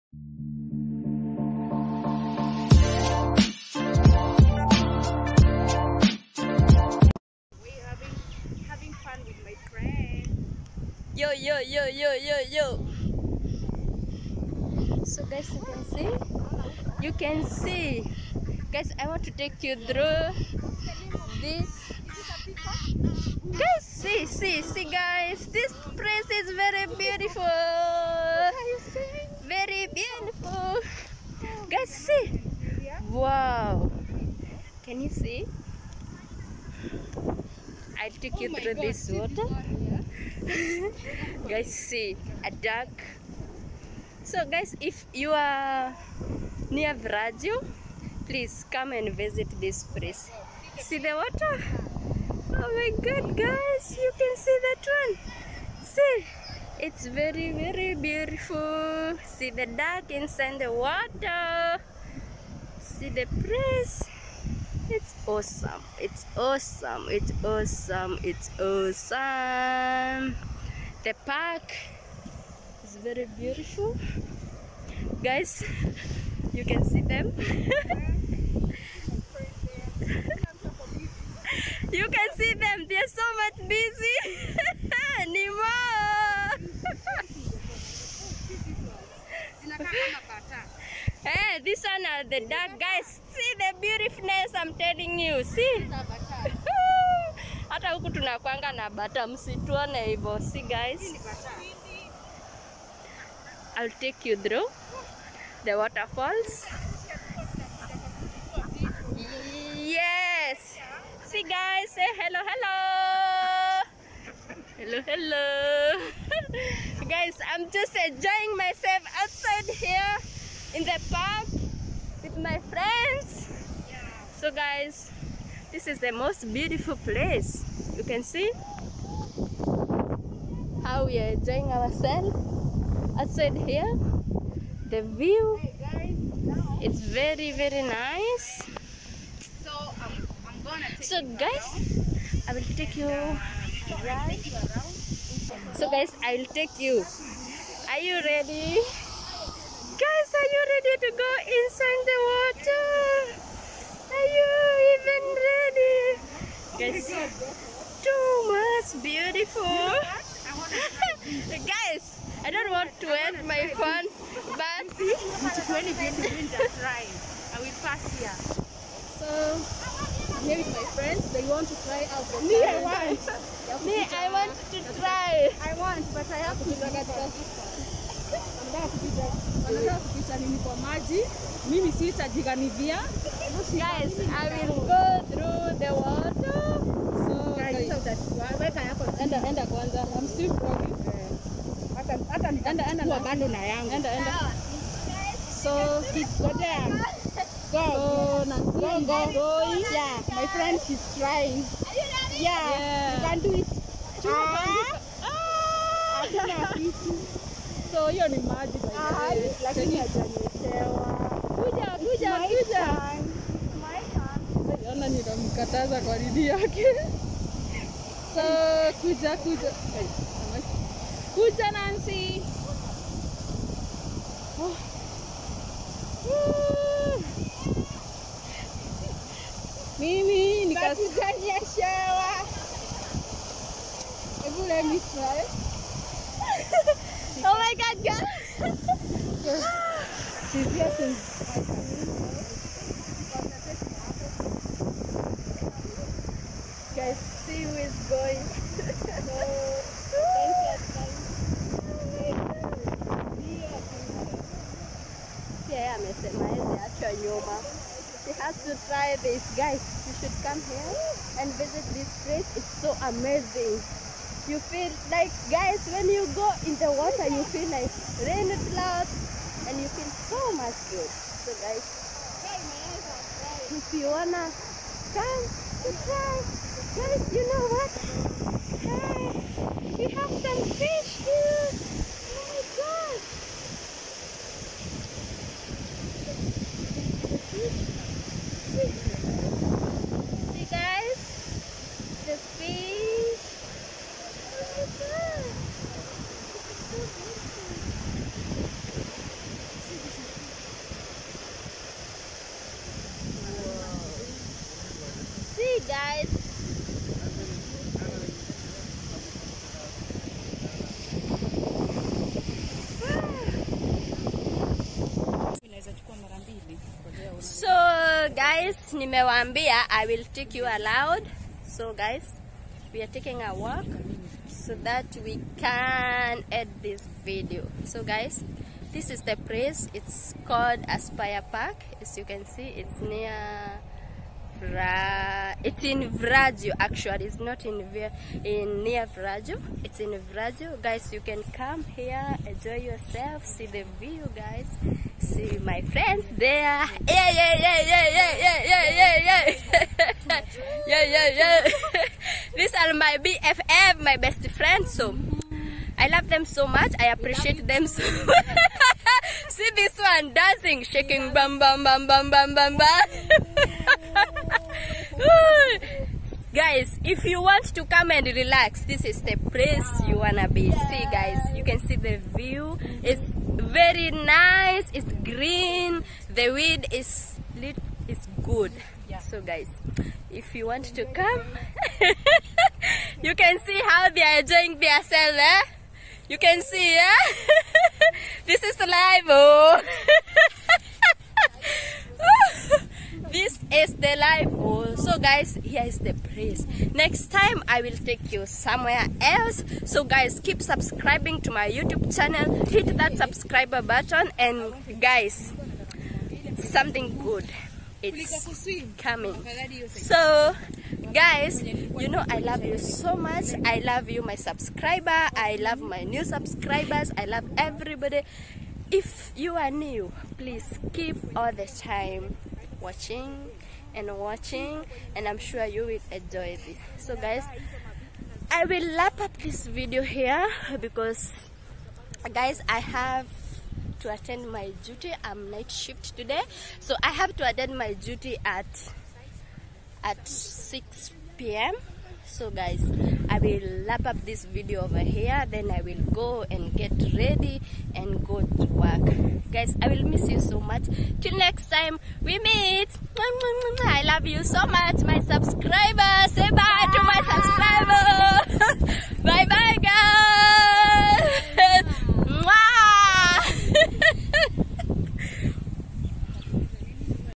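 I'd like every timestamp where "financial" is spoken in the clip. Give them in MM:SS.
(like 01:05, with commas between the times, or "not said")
not said.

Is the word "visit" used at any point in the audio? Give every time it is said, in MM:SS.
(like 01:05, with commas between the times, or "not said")
00:49, 04:21.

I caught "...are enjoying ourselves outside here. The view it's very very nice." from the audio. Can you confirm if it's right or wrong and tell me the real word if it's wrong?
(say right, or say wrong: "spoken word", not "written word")
right.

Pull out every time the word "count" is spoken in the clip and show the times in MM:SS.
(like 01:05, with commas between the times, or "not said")
not said.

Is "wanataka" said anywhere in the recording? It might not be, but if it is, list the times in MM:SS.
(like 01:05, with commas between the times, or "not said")
02:59.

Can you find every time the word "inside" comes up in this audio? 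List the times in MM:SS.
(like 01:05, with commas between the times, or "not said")
01:00, 02:31.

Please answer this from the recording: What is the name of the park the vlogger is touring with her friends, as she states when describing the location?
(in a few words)
Aspire Park.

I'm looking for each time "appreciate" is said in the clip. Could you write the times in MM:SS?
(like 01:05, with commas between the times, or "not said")
05:57.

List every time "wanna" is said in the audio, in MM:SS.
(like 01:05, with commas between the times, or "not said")
04:34, 06:10.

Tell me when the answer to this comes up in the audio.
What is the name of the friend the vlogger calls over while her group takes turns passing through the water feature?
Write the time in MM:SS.
03:41.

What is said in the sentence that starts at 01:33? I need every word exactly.
See the beautifulness I'm telling you.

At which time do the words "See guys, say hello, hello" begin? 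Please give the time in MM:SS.
01:51.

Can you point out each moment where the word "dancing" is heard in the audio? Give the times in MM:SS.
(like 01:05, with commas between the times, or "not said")
06:00.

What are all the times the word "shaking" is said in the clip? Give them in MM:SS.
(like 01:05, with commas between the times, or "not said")
06:00.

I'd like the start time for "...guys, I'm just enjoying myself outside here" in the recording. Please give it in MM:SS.
01:57.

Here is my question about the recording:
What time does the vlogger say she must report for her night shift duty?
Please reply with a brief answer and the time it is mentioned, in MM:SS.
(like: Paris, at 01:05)
6 p.m., at 07:20.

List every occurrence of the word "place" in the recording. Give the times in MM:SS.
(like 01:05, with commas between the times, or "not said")
00:25, 00:49, 01:03, 02:07, 04:22, 05:29, 06:09, 06:36.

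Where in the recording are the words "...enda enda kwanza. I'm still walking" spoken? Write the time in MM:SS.
03:09.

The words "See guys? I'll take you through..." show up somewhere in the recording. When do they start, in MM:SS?
01:40.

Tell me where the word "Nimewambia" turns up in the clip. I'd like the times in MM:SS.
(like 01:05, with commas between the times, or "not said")
05:18.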